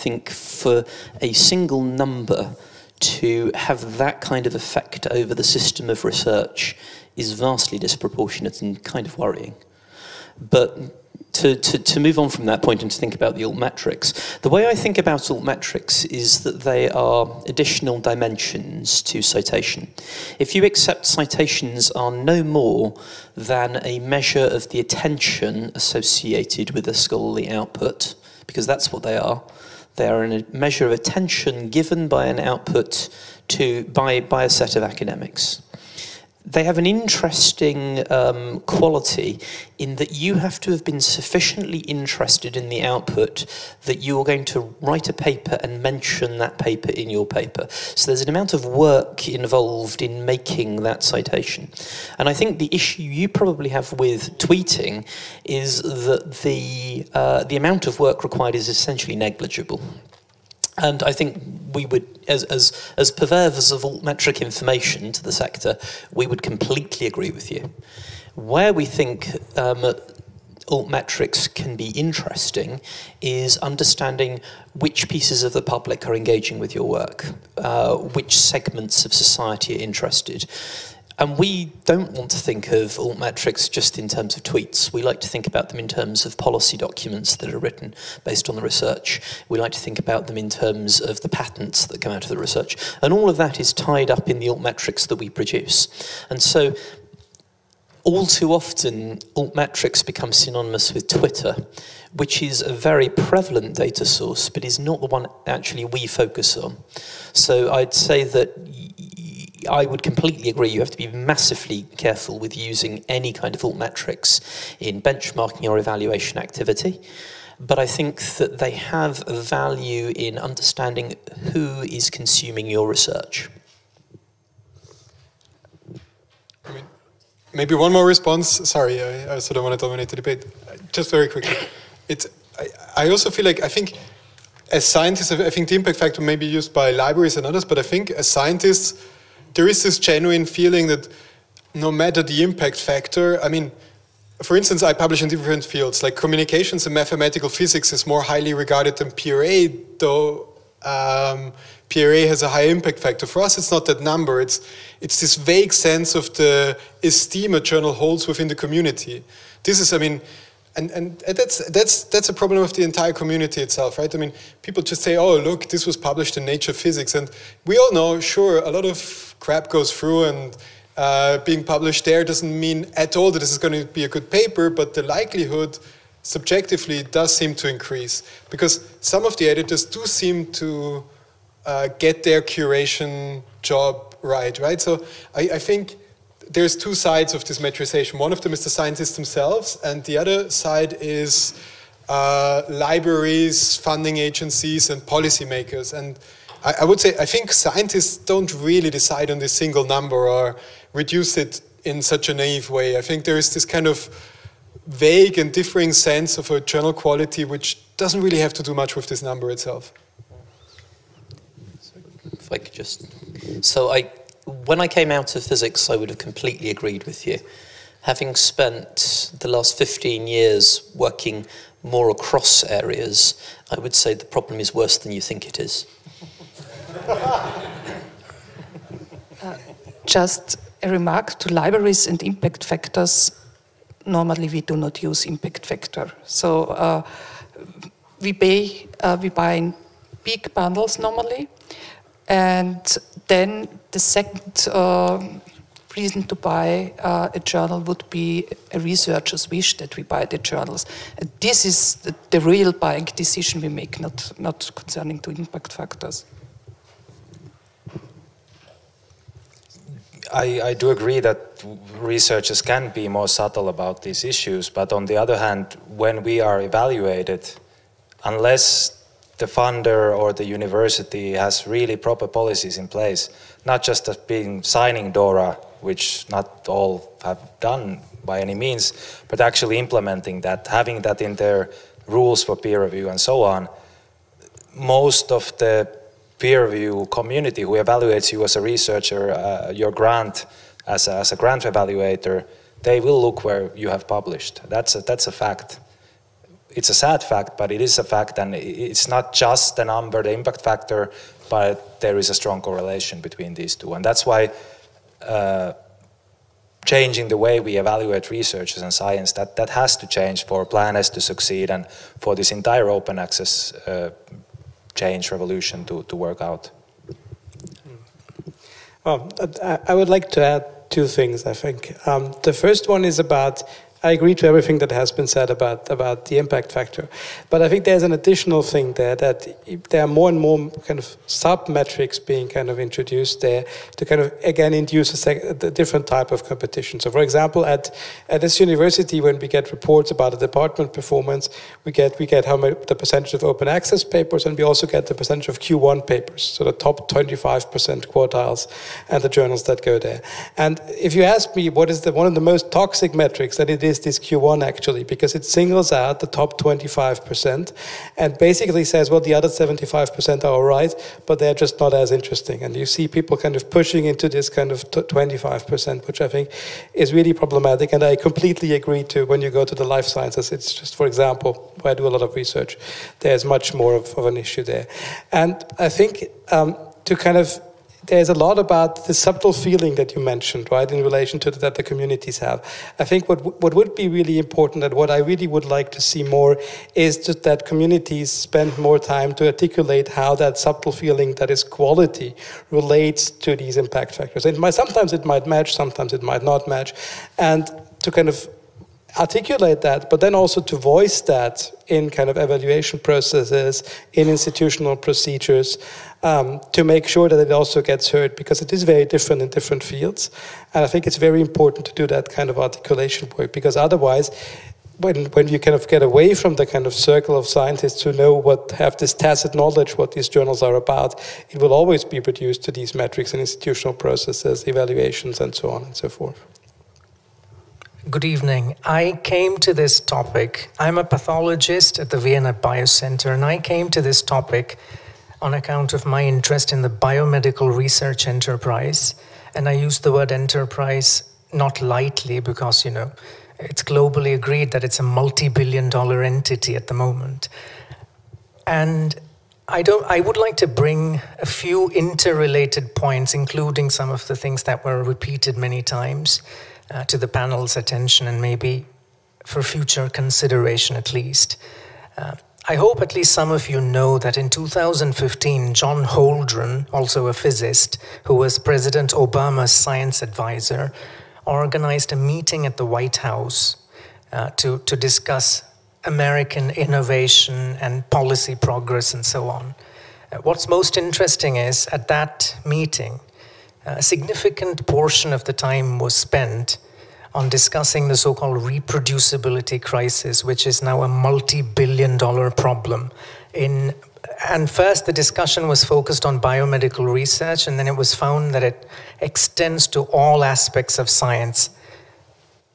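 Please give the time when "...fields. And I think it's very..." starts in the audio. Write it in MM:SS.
06:49.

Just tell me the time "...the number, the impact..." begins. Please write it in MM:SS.
04:59.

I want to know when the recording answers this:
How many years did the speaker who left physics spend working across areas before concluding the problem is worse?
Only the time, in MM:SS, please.
03:39.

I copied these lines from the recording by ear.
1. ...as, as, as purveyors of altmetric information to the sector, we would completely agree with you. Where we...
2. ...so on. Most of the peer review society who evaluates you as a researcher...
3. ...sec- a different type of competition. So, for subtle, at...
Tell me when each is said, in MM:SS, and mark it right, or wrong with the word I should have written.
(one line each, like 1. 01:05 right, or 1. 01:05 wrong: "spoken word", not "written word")
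1. 01:02 right
2. 04:43 wrong: "community", not "society"
3. 05:35 wrong: "example", not "subtle".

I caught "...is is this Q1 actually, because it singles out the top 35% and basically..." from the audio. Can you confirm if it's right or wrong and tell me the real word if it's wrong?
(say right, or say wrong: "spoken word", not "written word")
wrong: "25", not "35".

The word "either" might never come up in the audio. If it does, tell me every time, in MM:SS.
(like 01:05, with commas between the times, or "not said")
not said.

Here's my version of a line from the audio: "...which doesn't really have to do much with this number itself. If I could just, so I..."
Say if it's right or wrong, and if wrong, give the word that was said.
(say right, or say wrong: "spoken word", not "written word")
right.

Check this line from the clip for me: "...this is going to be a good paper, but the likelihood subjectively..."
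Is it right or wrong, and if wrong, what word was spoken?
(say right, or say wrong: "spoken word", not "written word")
right.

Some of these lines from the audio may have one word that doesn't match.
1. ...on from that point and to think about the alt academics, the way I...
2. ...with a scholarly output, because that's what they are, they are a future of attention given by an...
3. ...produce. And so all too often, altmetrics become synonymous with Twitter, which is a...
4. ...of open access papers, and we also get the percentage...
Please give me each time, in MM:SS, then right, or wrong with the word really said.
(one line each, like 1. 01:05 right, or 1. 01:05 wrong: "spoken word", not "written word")
1. 00:12 wrong: "metrics", not "academics"
2. 00:26 wrong: "measure", not "future"
3. 01:35 right
4. 05:43 right.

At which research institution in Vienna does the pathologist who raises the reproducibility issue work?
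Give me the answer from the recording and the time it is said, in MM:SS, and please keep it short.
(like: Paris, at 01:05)
Vienna Biocenter, at 07:12.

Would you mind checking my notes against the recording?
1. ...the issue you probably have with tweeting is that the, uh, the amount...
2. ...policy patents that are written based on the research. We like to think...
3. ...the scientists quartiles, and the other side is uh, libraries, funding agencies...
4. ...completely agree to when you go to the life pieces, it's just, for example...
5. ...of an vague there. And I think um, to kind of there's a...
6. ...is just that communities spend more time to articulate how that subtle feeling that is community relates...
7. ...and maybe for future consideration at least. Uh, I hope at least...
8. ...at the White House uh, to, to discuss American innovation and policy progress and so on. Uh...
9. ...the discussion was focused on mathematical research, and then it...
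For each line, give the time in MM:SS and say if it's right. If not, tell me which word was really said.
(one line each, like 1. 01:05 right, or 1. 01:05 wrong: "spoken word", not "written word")
1. 00:52 right
2. 01:26 wrong: "documents", not "patents"
3. 03:08 wrong: "themselves", not "quartiles"
4. 06:08 wrong: "sciences", not "pieces"
5. 06:14 wrong: "issue", not "vague"
6. 06:26 wrong: "quality", not "community"
7. 07:38 right
8. 07:52 right
9. 08:15 wrong: "biomedical", not "mathematical".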